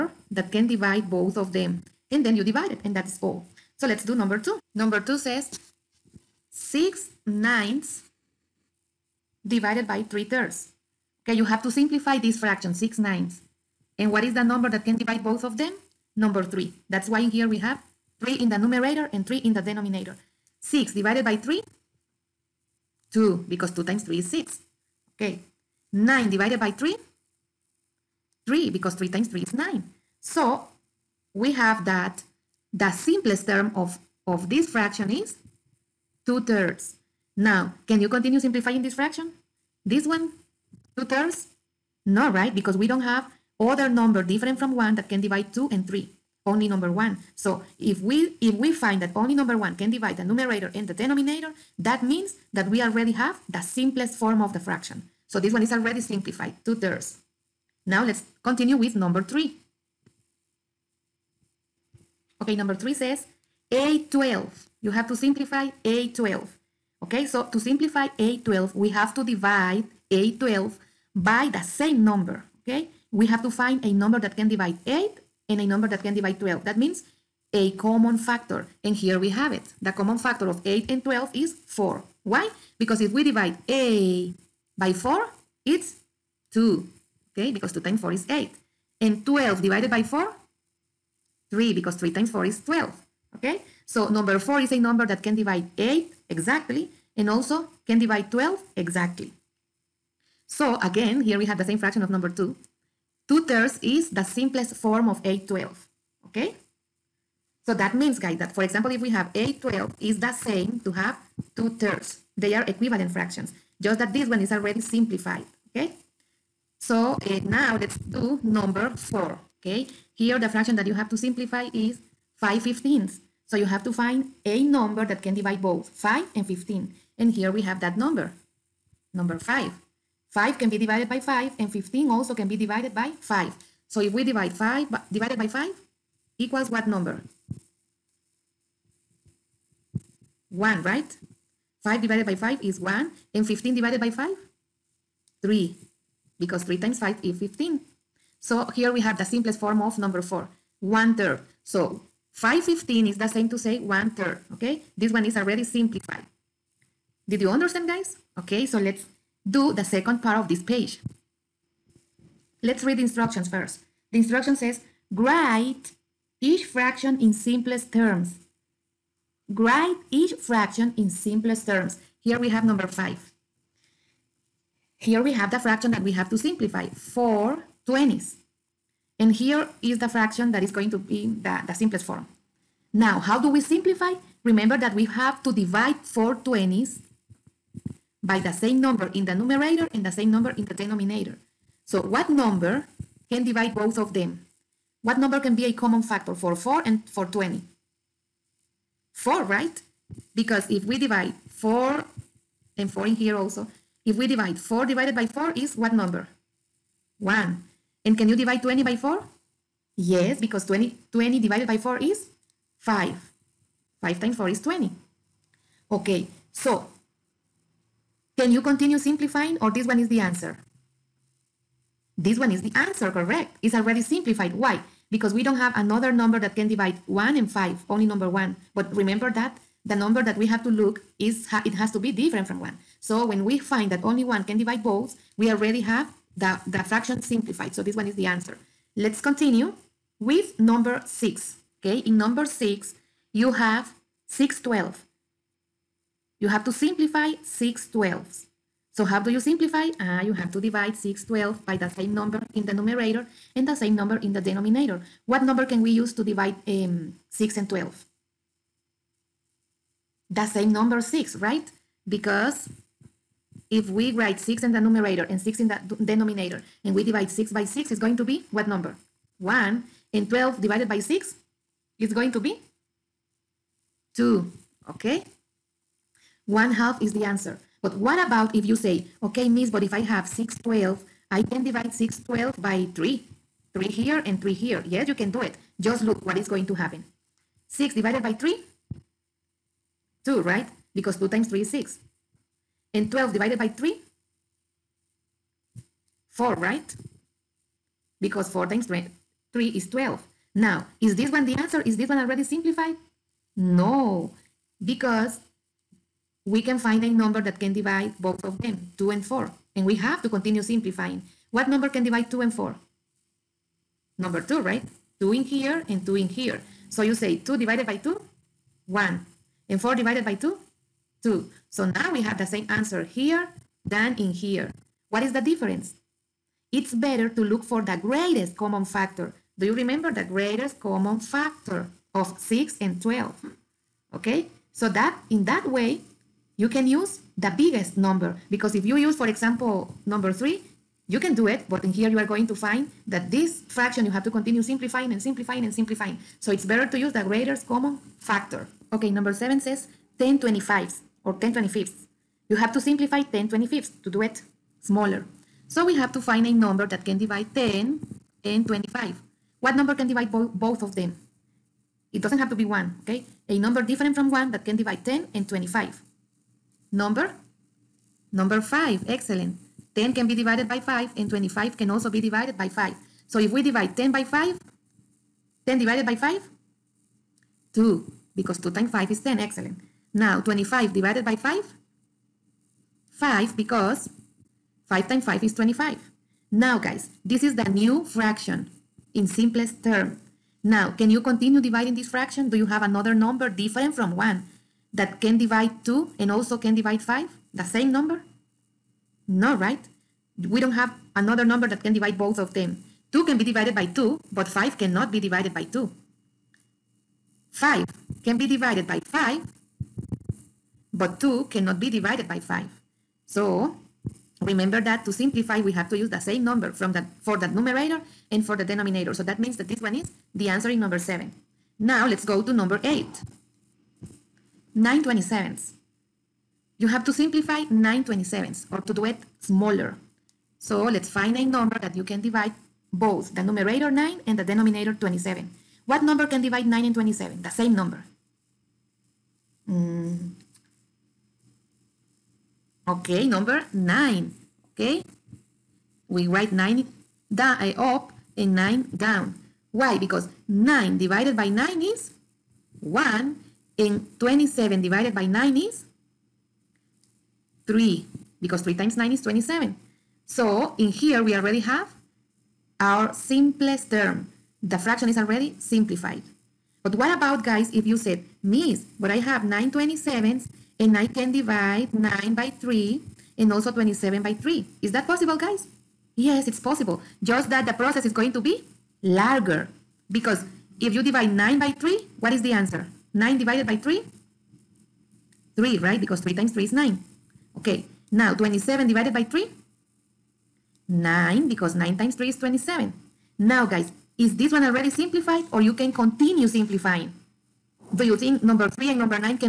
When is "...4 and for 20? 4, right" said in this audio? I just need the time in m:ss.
3:16.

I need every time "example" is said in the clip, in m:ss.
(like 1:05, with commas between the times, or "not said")
1:48, 5:39.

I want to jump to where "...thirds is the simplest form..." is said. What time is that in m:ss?
1:43.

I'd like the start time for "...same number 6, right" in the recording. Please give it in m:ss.
4:20.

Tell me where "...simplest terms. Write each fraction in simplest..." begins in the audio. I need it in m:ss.
2:47.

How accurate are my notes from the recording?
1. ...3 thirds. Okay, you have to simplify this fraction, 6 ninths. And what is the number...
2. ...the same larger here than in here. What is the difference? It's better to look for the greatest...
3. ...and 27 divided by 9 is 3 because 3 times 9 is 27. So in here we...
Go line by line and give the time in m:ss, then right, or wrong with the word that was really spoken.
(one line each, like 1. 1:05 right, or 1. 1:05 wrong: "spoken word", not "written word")
1. 0:10 right
2. 5:22 wrong: "answer", not "larger"
3. 7:33 right.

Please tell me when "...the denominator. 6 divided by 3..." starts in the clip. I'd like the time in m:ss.
0:19.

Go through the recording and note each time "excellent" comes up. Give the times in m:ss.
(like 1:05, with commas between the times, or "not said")
6:09, 6:19.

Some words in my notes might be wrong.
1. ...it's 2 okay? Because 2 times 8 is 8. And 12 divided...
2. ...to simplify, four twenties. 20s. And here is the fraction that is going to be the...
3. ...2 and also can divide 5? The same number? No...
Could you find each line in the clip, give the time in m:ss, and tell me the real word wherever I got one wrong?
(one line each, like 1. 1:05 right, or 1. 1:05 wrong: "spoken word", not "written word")
1. 1:25 wrong: "4", not "8"
2. 2:56 right
3. 6:35 right.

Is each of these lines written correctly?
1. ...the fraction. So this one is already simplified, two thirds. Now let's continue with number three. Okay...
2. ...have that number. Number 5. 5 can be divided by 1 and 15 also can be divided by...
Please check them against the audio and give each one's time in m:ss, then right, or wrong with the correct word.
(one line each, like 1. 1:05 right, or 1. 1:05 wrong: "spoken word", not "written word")
1. 0:54 right
2. 2:07 wrong: "5", not "1".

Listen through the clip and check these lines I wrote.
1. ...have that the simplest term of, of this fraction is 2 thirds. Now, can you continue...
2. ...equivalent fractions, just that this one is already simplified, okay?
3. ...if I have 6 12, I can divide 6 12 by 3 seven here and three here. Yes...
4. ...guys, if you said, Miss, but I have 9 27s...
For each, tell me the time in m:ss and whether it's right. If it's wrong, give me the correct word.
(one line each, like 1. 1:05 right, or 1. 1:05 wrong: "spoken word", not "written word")
1. 0:31 right
2. 1:52 right
3. 4:39 wrong: "three", not "seven"
4. 7:47 right.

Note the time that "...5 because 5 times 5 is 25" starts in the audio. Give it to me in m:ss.
6:23.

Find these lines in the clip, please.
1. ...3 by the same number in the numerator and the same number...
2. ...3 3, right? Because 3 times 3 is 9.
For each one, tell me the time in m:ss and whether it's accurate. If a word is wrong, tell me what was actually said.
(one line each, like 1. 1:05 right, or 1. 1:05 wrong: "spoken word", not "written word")
1. 4:10 wrong: "6", not "3"
2. 8:03 right.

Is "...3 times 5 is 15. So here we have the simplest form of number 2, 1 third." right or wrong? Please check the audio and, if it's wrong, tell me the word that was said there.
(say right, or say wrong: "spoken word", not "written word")
wrong: "4", not "2".